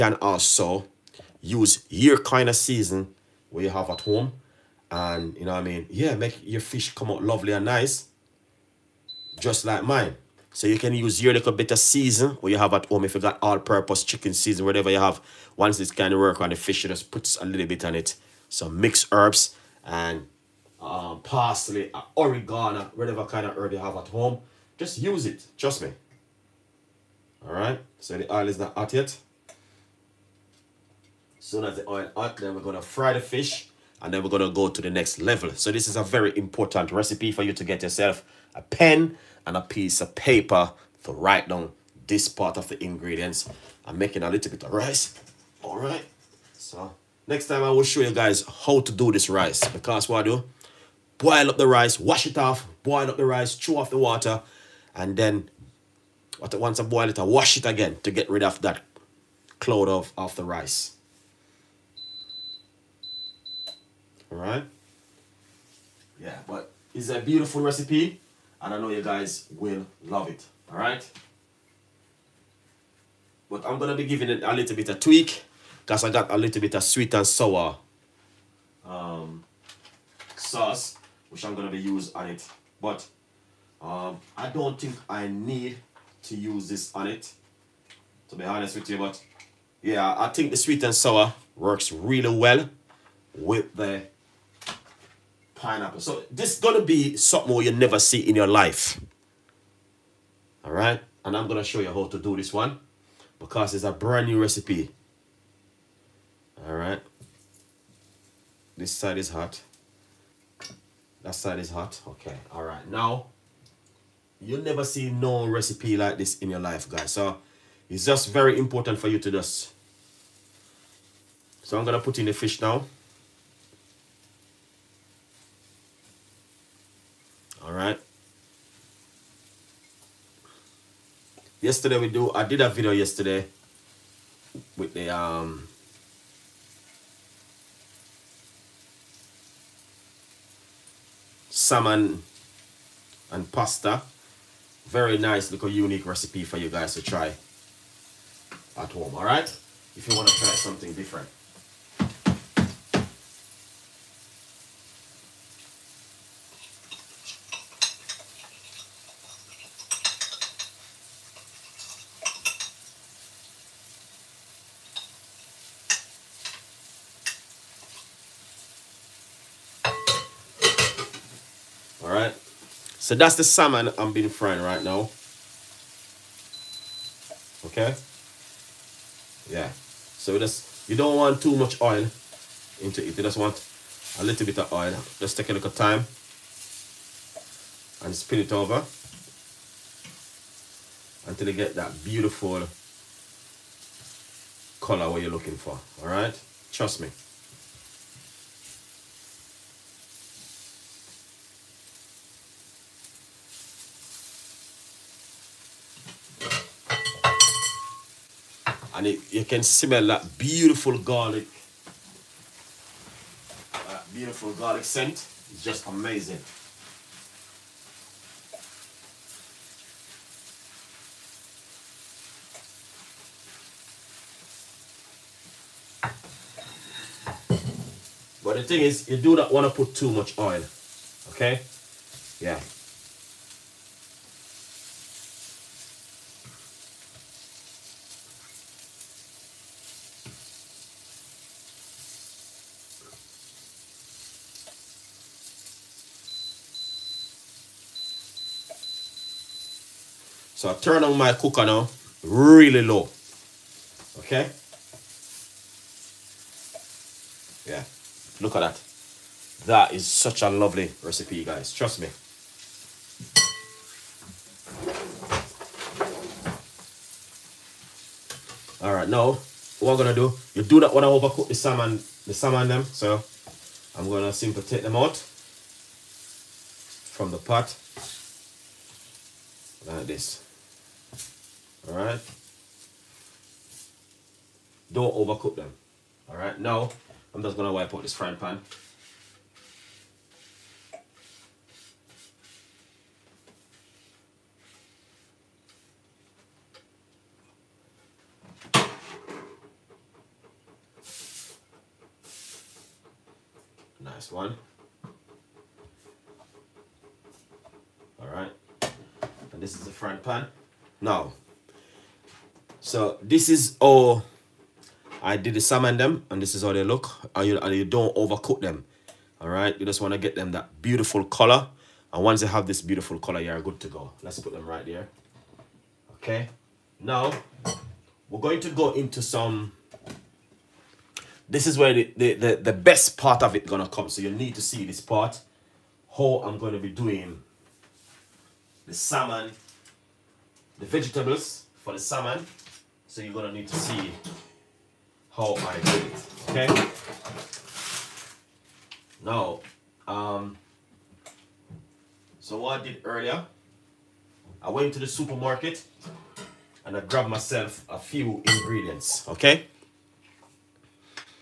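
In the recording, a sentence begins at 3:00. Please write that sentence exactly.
So just, you don't want too much oil into it.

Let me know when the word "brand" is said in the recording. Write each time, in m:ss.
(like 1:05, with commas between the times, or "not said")
1:43.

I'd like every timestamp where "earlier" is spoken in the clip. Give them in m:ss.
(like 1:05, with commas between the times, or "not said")
5:53.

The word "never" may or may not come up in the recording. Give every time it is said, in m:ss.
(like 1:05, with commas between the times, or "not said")
1:37, 1:54.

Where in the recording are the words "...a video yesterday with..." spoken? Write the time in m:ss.
2:12.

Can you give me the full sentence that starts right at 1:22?
But um, I don't think I need to use this on it, to be honest with you.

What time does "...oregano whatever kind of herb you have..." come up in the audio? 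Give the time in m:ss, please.
0:22.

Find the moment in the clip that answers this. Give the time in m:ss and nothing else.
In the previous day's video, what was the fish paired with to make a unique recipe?
2:23.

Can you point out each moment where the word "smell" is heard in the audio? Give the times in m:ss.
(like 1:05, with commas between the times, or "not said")
3:29.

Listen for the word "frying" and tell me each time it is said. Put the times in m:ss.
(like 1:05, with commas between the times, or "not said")
2:54, 4:48.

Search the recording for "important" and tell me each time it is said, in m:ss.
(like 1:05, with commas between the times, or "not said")
0:36, 1:58.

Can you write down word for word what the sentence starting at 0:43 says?
I'm making a little bit of rice.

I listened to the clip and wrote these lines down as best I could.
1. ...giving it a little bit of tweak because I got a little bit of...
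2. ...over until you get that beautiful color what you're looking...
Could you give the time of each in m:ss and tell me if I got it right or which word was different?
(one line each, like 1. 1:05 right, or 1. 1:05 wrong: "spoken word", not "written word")
1. 1:14 right
2. 3:08 right.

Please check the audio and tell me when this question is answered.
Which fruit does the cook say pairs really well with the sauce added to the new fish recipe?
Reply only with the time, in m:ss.
1:35.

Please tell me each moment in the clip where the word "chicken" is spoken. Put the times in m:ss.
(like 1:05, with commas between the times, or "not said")
0:14.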